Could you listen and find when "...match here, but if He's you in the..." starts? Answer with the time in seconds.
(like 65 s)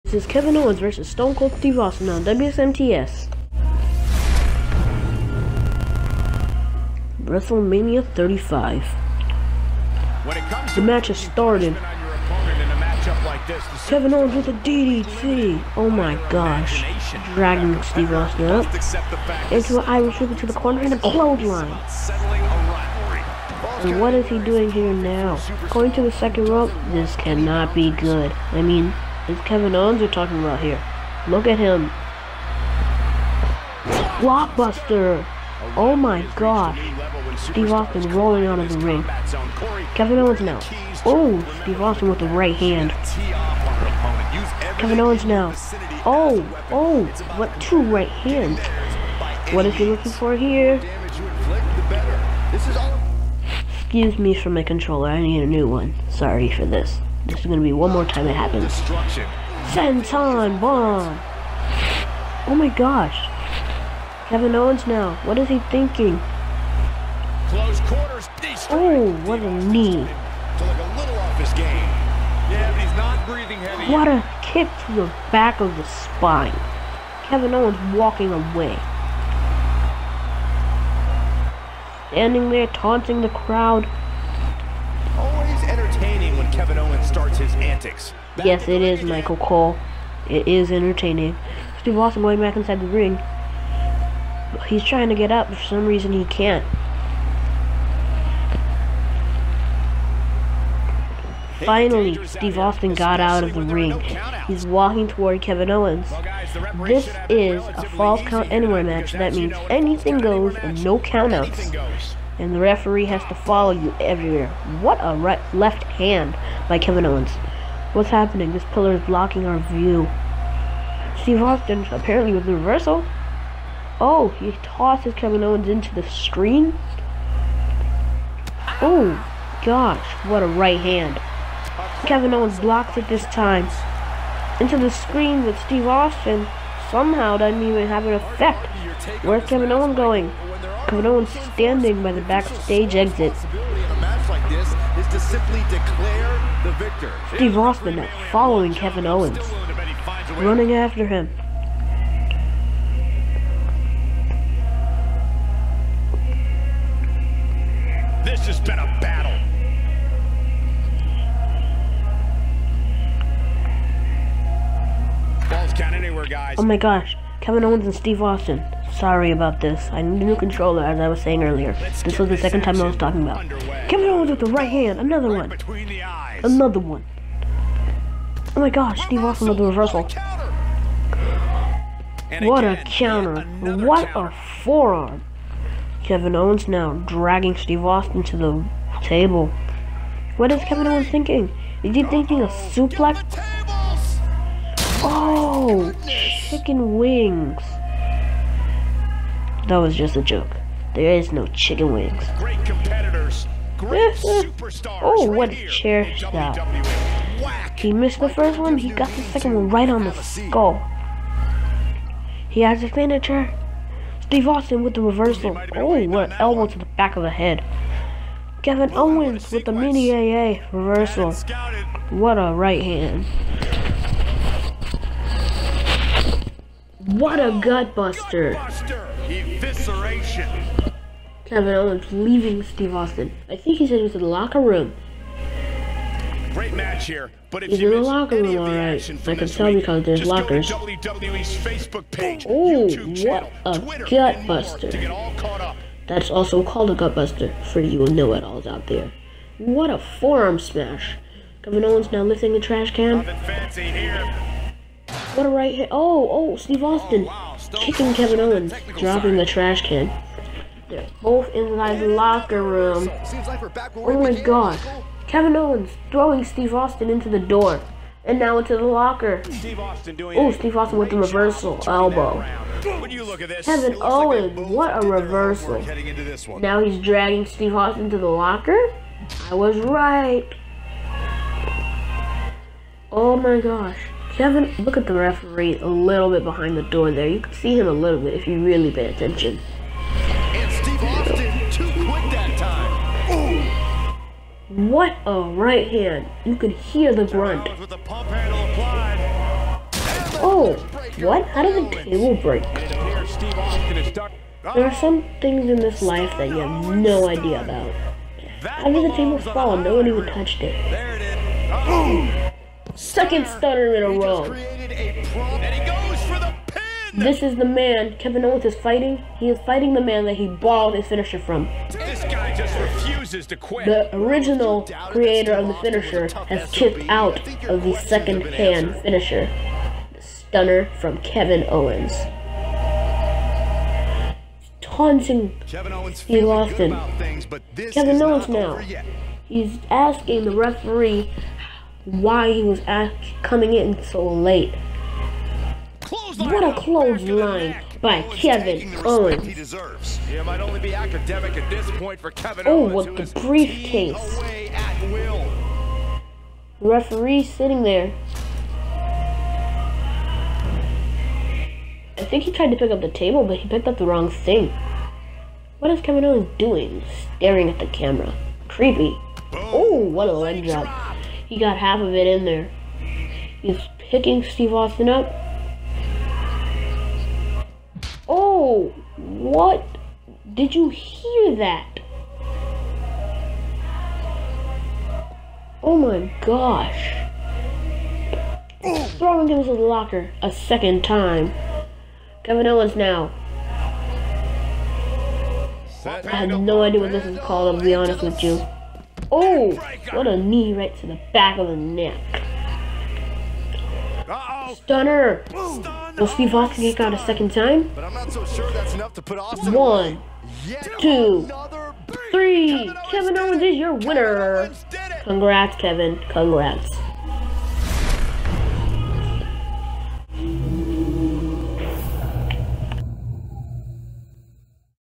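236 s.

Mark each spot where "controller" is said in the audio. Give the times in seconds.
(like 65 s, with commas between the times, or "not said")
54 s, 170 s.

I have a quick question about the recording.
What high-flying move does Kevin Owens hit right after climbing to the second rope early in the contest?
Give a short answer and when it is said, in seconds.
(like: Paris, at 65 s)
Blockbuster, at 34 s.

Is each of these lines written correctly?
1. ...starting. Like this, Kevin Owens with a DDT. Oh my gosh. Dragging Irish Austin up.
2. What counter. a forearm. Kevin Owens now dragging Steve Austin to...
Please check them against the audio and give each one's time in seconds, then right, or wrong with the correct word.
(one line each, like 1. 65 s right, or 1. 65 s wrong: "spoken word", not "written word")
1. 11 s wrong: "Steve", not "Irish"
2. 183 s right.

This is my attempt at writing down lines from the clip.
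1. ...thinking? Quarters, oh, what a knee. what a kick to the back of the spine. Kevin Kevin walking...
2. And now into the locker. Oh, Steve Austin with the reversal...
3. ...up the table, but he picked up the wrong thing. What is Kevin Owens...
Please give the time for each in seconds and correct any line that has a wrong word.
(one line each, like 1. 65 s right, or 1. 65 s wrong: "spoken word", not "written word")
1. 65 s wrong: "Owens", not "Kevin"
2. 268 s right
3. 362 s right.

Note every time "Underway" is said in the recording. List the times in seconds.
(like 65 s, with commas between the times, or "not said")
173 s.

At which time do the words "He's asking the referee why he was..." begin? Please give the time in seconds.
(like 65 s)
339 s.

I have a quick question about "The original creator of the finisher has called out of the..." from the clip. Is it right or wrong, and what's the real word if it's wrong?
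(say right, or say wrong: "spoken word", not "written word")
wrong: "kicked", not "called".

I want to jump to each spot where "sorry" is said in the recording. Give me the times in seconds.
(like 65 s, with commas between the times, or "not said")
56 s, 169 s.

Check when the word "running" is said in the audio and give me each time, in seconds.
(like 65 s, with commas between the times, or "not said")
150 s.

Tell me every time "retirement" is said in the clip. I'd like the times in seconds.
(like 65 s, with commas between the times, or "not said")
not said.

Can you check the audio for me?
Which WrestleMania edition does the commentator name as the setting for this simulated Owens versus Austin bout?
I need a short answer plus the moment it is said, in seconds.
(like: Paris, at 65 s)
WrestleMania 35, at 7 s.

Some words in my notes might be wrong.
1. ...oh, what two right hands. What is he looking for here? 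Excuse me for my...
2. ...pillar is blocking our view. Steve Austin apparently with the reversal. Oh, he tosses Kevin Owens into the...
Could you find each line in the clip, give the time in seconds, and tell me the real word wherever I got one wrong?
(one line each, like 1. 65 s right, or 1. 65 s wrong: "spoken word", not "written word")
1. 46 s right
2. 118 s right.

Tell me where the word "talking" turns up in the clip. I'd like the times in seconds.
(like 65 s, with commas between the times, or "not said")
30 s, 172 s.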